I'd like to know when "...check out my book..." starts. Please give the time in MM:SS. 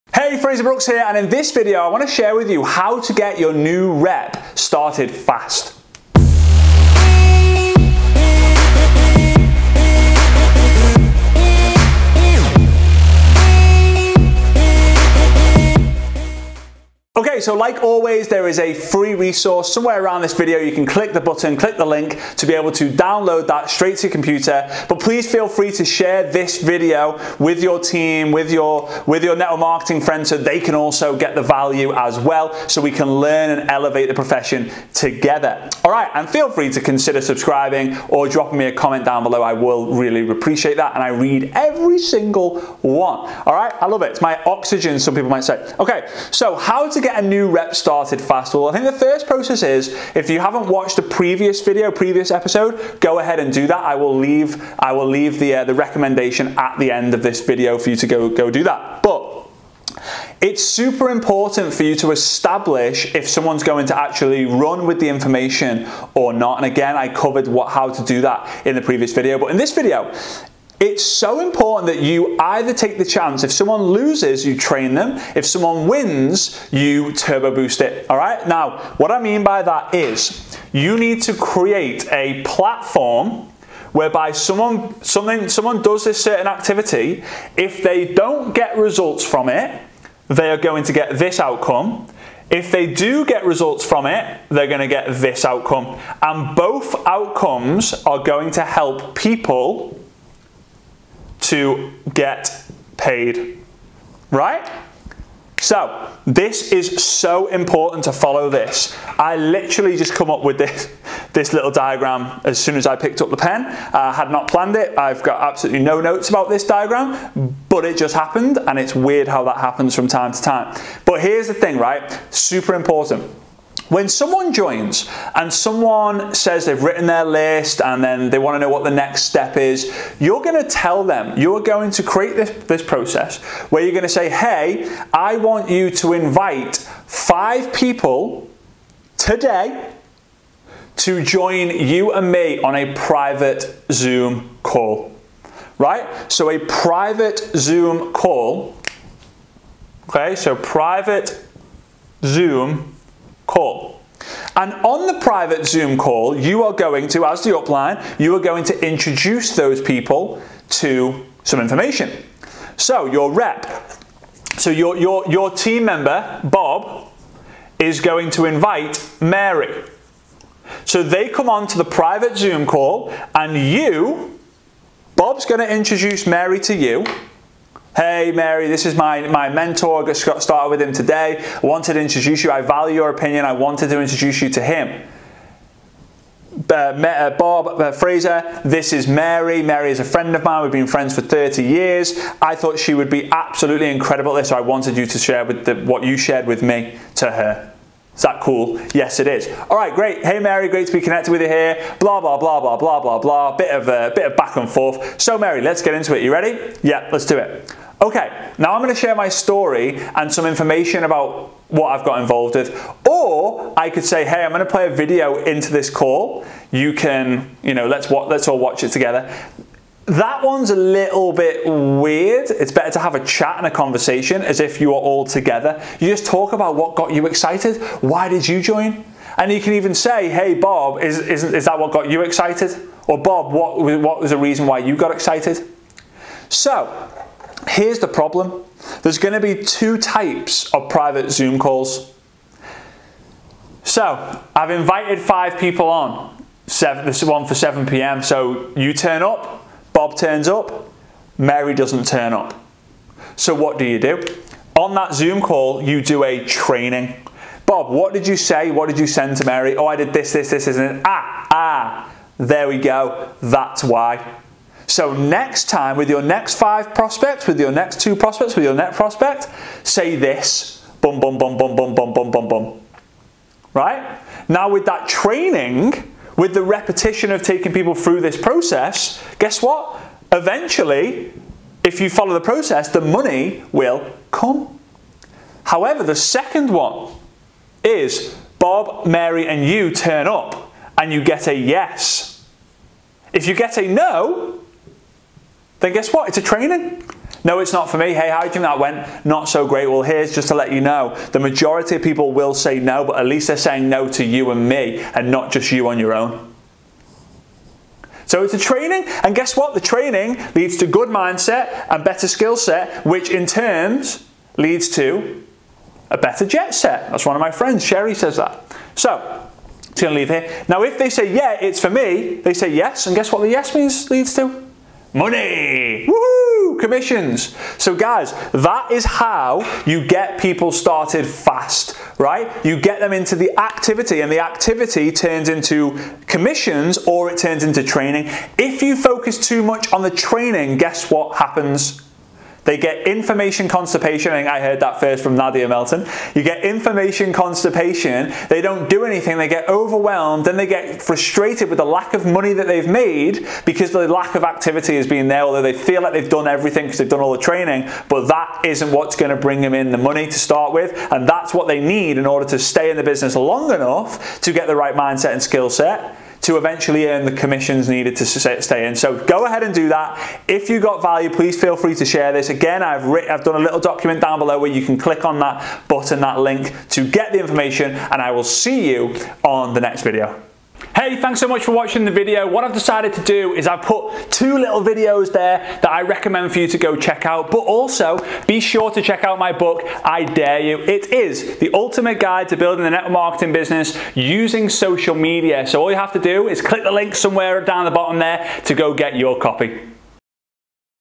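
06:29.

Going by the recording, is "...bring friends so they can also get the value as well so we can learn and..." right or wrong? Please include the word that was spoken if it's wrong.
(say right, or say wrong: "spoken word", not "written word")
wrong: "marketing", not "bring".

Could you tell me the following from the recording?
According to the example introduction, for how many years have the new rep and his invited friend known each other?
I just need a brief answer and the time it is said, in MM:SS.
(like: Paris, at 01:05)
30, at 03:11.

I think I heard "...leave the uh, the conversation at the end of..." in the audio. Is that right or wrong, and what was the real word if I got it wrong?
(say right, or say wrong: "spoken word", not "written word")
wrong: "recommendation", not "conversation".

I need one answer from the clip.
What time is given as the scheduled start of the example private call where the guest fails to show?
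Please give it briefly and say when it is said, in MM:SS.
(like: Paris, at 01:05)
7 p.m., at 04:07.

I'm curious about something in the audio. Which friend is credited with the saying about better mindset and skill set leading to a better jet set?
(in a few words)
Sherry.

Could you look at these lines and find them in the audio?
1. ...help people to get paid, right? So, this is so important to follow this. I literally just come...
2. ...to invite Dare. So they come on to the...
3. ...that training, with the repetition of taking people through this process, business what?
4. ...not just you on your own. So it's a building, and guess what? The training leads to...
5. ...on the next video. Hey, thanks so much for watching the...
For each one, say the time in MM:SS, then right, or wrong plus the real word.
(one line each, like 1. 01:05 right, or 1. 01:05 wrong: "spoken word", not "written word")
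1. 01:38 right
2. 02:48 wrong: "Mary", not "Dare"
3. 04:34 wrong: "guess", not "business"
4. 05:05 wrong: "training", not "building"
5. 06:19 right.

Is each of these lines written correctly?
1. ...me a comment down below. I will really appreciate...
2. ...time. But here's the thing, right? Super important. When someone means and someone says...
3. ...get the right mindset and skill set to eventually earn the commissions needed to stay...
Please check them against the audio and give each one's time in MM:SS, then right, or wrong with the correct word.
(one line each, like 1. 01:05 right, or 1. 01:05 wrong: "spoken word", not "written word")
1. 00:38 right
2. 02:00 wrong: "joins", not "means"
3. 06:04 right.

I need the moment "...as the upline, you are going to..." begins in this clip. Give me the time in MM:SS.
02:37.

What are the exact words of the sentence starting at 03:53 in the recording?
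Or Bob, what, what was the reason why you got excited?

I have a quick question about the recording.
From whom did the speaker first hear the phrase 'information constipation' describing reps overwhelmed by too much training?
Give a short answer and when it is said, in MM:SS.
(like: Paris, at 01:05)
Nadia Melton, at 05:45.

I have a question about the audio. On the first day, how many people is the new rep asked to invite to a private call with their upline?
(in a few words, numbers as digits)
5.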